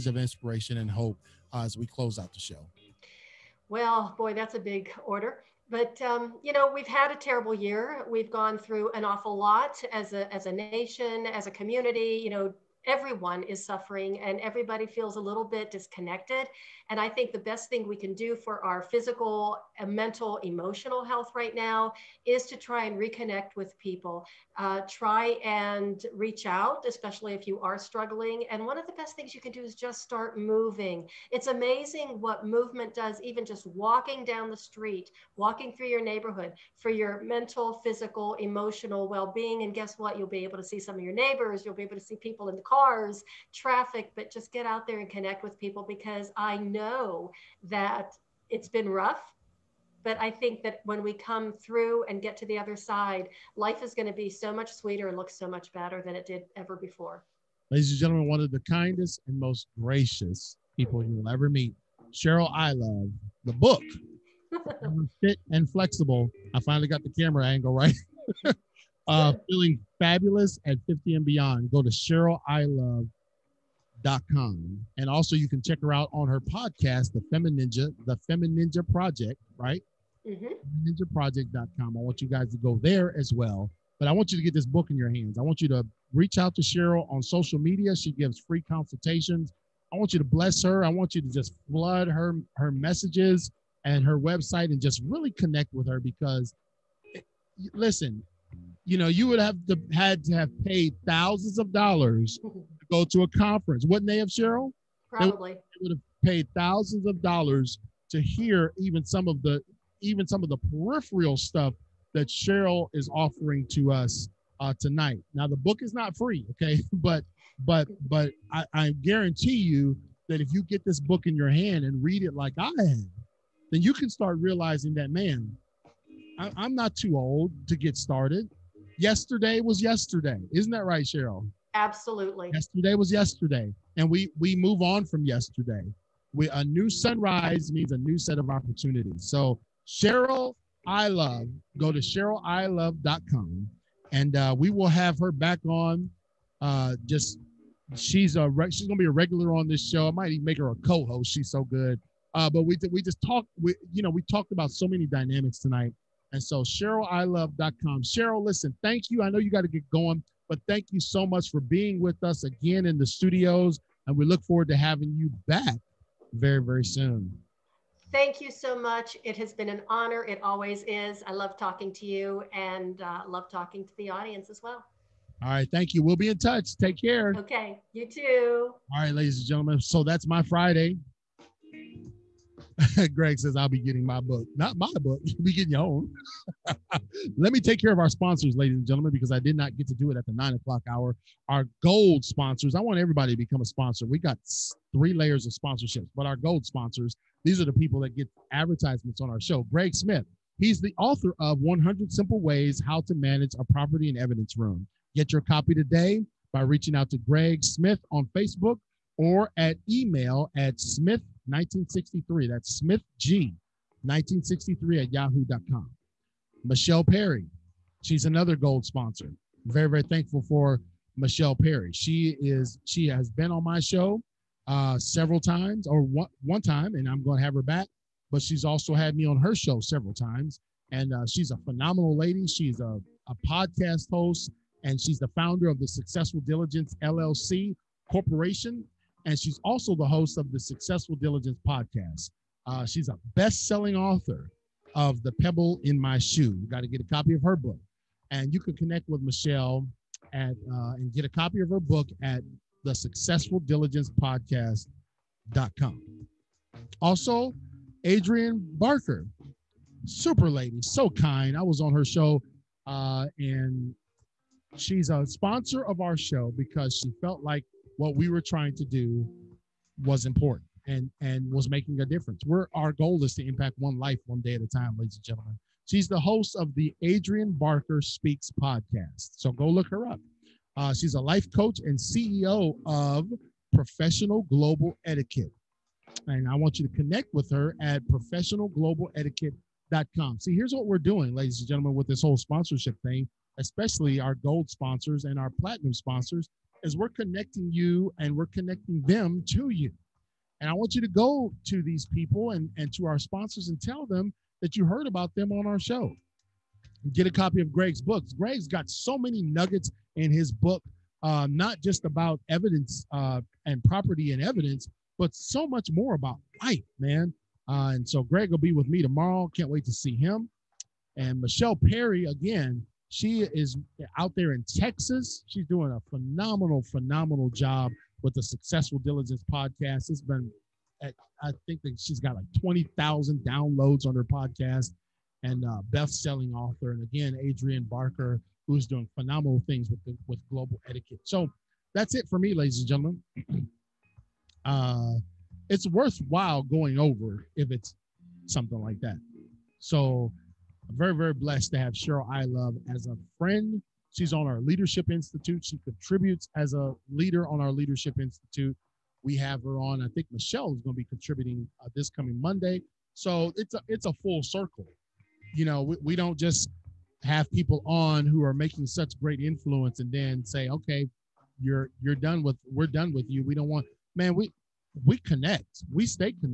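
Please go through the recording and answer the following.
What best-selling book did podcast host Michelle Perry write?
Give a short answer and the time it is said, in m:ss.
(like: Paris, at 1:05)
The Pebble in My Shoe, at 4:05.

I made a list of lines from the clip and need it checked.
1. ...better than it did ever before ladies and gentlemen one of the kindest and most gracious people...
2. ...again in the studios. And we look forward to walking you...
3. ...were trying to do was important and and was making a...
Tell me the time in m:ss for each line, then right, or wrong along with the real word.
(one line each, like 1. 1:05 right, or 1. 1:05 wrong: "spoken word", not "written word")
1. 0:55 right
2. 2:42 wrong: "having", not "walking"
3. 4:28 right.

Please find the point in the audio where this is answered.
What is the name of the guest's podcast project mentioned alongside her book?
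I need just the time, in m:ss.
1:18.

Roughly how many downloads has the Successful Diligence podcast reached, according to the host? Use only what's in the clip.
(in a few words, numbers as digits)
20,000.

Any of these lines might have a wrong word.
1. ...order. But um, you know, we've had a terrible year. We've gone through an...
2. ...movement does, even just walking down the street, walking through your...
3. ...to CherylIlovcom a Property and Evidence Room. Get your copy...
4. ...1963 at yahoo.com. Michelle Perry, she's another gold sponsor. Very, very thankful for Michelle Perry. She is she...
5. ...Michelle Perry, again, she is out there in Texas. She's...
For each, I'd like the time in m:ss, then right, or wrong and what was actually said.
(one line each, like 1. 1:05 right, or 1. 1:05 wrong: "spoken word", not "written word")
1. 0:05 right
2. 0:32 right
3. 3:23 wrong: "Manage", not "CherylIlovcom"
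4. 3:34 right
5. 5:21 right.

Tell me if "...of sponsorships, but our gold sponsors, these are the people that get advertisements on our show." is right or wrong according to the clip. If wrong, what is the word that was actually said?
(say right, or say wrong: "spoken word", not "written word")
right.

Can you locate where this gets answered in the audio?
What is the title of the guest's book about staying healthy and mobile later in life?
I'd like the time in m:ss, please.
1:05.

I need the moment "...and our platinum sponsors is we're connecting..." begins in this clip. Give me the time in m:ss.
4:55.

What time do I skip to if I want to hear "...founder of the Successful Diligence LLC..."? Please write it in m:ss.
3:55.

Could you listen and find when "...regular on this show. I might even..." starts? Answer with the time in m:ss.
2:29.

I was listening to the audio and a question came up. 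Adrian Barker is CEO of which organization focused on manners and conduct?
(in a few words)
Professional Global Etiquette.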